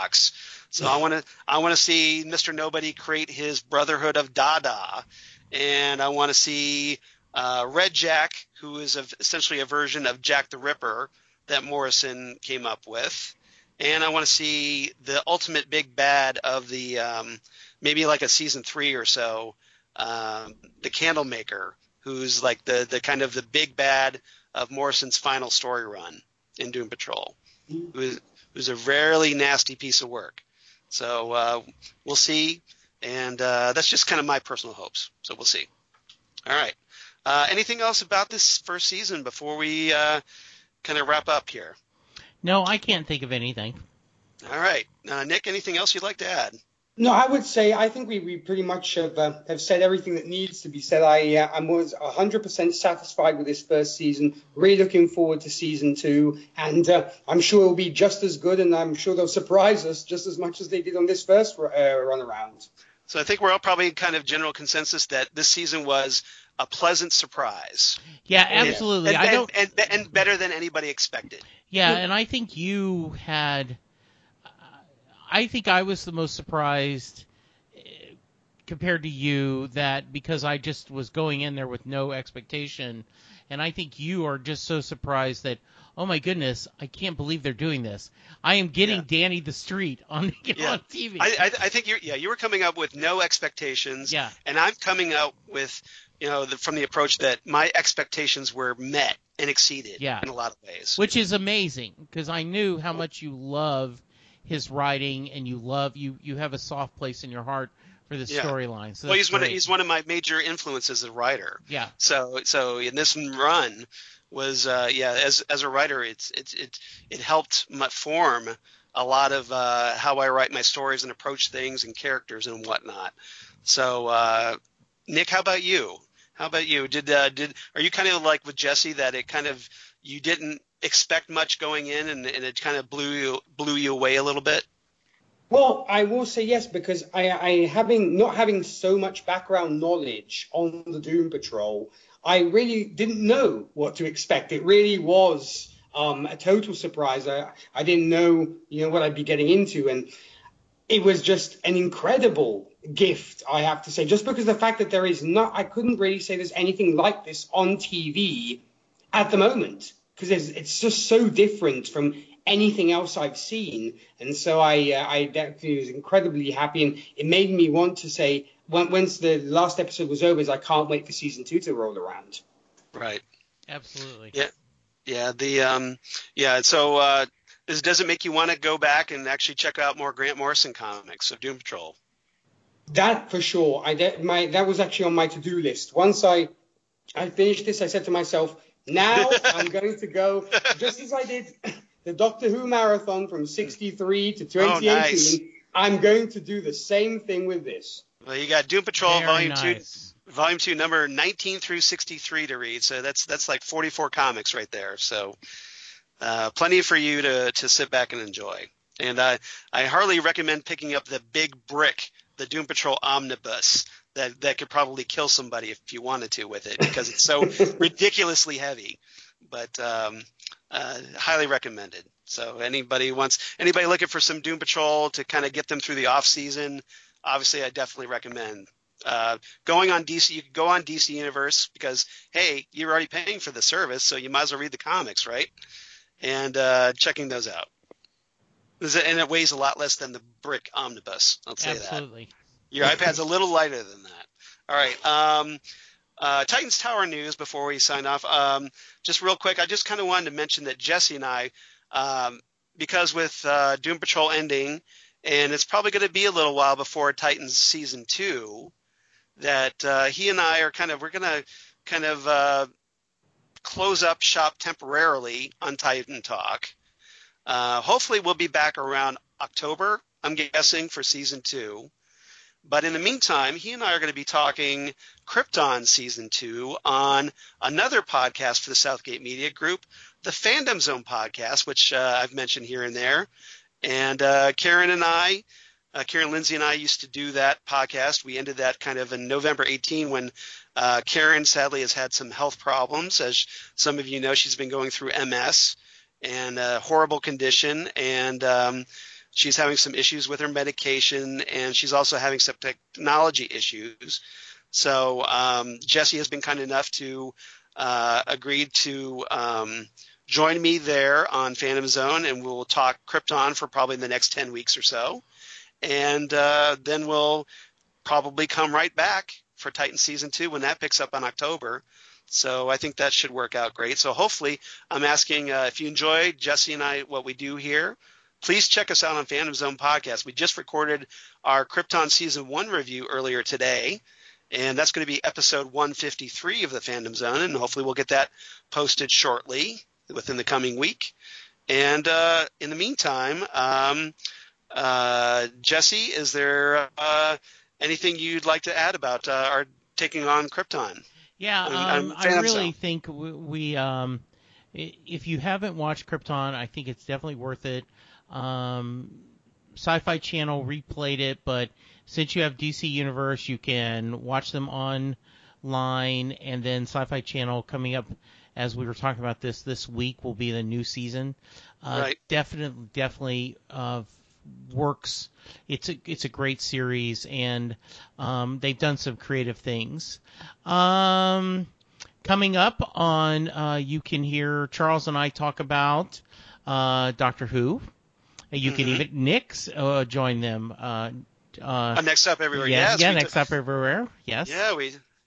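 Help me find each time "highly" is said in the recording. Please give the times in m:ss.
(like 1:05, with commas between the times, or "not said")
3:41.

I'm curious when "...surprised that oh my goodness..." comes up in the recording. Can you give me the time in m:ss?
1:24.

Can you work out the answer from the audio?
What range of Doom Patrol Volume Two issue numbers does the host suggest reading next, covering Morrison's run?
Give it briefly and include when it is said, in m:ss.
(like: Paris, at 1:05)
19 through 63, at 3:21.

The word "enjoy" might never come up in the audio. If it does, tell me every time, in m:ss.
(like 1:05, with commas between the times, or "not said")
3:28, 5:25.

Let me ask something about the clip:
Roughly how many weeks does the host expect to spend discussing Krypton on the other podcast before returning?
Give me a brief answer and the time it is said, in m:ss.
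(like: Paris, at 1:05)
10, at 5:14.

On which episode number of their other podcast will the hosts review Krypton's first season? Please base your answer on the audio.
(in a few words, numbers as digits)
153.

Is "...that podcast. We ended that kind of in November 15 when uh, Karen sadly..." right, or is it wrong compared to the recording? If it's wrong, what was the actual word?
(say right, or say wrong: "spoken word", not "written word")
wrong: "18", not "15".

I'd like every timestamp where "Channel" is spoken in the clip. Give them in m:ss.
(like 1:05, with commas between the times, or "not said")
6:00, 6:07.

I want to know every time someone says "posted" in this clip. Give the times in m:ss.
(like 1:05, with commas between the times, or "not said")
5:38.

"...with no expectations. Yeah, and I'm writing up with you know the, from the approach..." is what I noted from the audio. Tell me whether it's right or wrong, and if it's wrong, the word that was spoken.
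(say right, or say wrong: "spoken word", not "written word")
wrong: "coming", not "writing".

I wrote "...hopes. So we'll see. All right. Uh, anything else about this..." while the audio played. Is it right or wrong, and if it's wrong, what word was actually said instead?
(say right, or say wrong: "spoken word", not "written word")
right.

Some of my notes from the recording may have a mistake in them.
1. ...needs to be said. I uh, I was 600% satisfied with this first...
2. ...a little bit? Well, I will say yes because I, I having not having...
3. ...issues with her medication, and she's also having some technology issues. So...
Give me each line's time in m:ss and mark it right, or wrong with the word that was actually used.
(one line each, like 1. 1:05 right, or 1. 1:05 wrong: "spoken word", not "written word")
1. 0:50 wrong: "100", not "600"
2. 2:14 right
3. 4:59 right.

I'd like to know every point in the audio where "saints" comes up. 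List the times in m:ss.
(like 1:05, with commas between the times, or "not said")
not said.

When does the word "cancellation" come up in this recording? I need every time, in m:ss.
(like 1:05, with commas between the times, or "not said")
not said.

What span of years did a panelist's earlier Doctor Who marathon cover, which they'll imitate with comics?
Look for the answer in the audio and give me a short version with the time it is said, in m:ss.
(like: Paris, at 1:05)
63 to 2018, at 3:13.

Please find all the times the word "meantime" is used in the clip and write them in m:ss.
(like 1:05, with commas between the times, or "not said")
4:32, 5:42.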